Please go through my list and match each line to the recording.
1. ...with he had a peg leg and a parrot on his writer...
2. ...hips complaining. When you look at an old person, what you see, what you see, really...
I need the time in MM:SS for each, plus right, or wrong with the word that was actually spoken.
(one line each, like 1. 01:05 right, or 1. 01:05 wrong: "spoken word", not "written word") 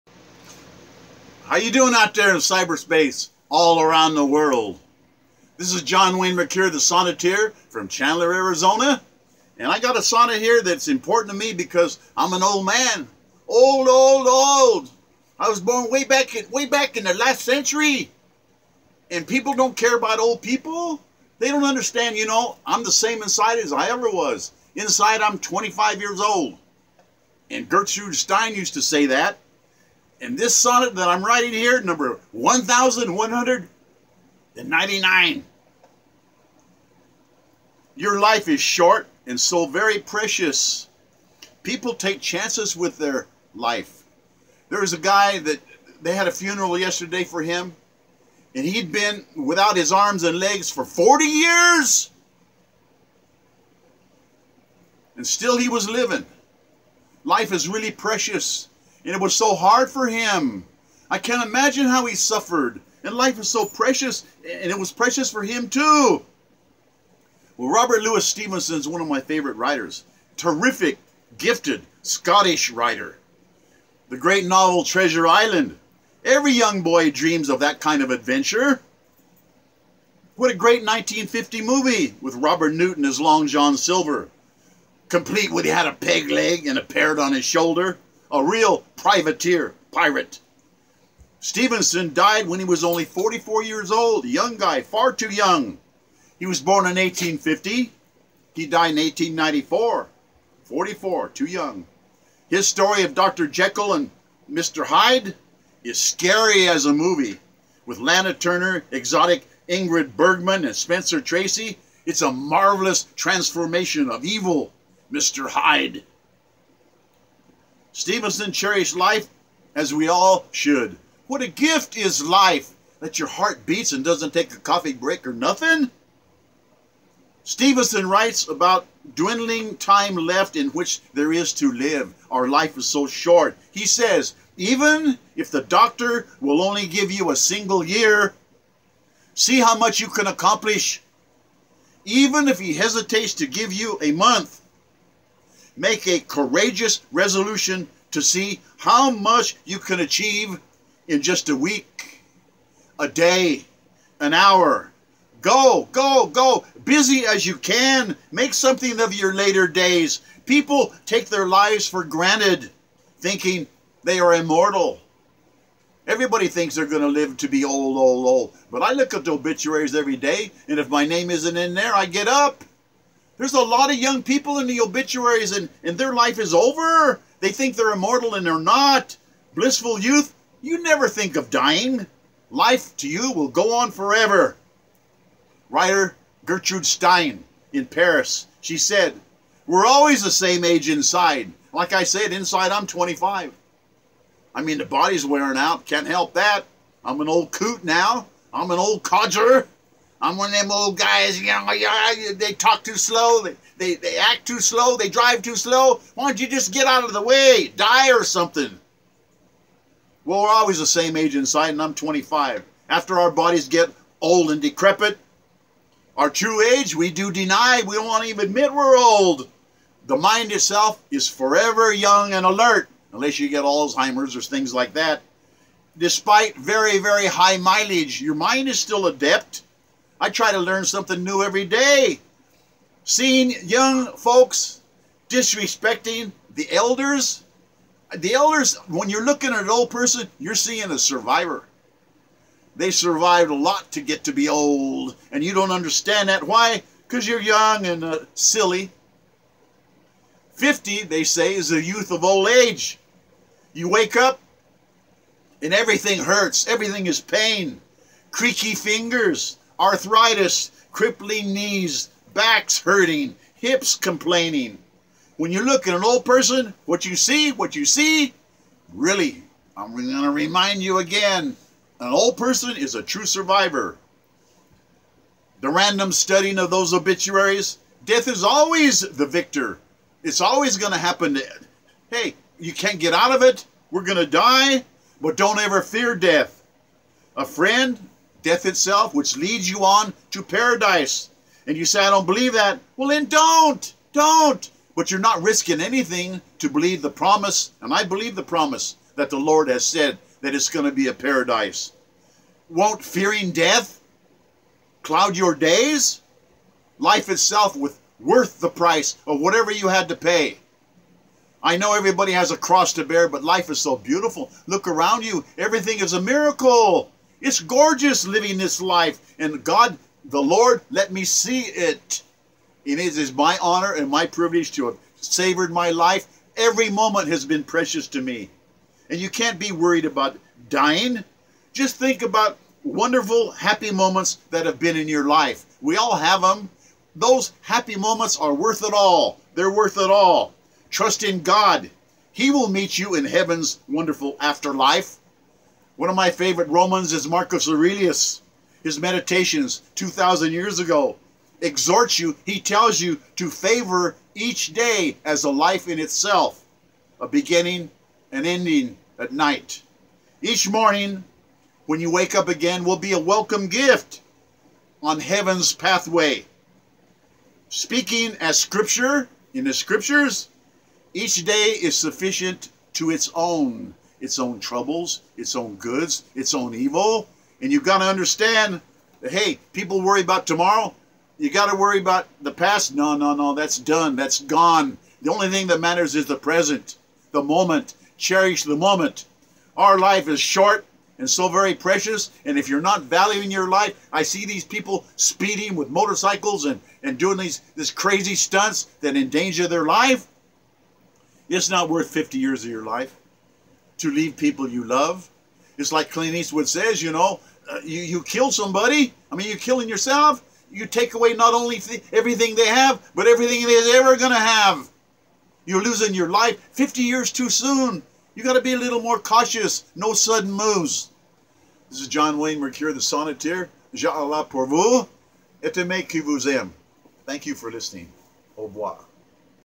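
1. 01:25 wrong: "shoulder", not "writer"
2. 04:23 right.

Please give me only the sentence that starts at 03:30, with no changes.
Well, we're always the same age inside, and I'm 25.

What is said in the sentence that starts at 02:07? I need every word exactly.
Stevenson writes about dwindling time left in which there is to live.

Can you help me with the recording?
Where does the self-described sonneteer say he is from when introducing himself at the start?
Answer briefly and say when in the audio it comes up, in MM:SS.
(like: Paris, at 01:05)
Chandler, Arizona, at 00:07.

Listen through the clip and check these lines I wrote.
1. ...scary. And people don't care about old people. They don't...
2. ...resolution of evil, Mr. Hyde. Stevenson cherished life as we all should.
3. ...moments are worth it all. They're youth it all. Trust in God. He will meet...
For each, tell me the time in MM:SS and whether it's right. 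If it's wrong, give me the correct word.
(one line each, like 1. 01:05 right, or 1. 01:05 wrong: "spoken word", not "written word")
1. 00:17 wrong: "century", not "scary"
2. 01:53 wrong: "transformation", not "resolution"
3. 05:37 wrong: "worth", not "youth".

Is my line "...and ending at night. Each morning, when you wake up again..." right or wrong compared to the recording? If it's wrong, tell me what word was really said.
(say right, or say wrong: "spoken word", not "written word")
right.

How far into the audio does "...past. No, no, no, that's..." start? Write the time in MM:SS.
06:22.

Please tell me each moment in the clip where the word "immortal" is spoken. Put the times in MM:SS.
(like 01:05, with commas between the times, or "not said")
02:44, 02:57.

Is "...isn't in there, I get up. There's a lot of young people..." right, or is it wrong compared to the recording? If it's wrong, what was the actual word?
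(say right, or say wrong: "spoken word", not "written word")
right.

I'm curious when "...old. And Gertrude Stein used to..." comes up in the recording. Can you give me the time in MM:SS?
00:26.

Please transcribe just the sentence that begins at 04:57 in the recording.
And I believe the promise that the Lord has said that it's going to be a paradise.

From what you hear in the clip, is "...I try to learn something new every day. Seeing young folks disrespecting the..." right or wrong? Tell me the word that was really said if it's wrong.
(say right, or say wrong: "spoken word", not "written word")
right.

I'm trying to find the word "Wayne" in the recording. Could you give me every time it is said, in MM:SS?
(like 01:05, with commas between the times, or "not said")
00:06, 07:02.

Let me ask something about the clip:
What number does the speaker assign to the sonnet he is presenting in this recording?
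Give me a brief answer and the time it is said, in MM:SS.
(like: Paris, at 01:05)
1199, at 00:31.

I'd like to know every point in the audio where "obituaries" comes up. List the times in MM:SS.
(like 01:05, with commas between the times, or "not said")
02:49, 02:54, 04:36.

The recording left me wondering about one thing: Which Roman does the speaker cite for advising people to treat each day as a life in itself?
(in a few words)
Marcus Aurelius.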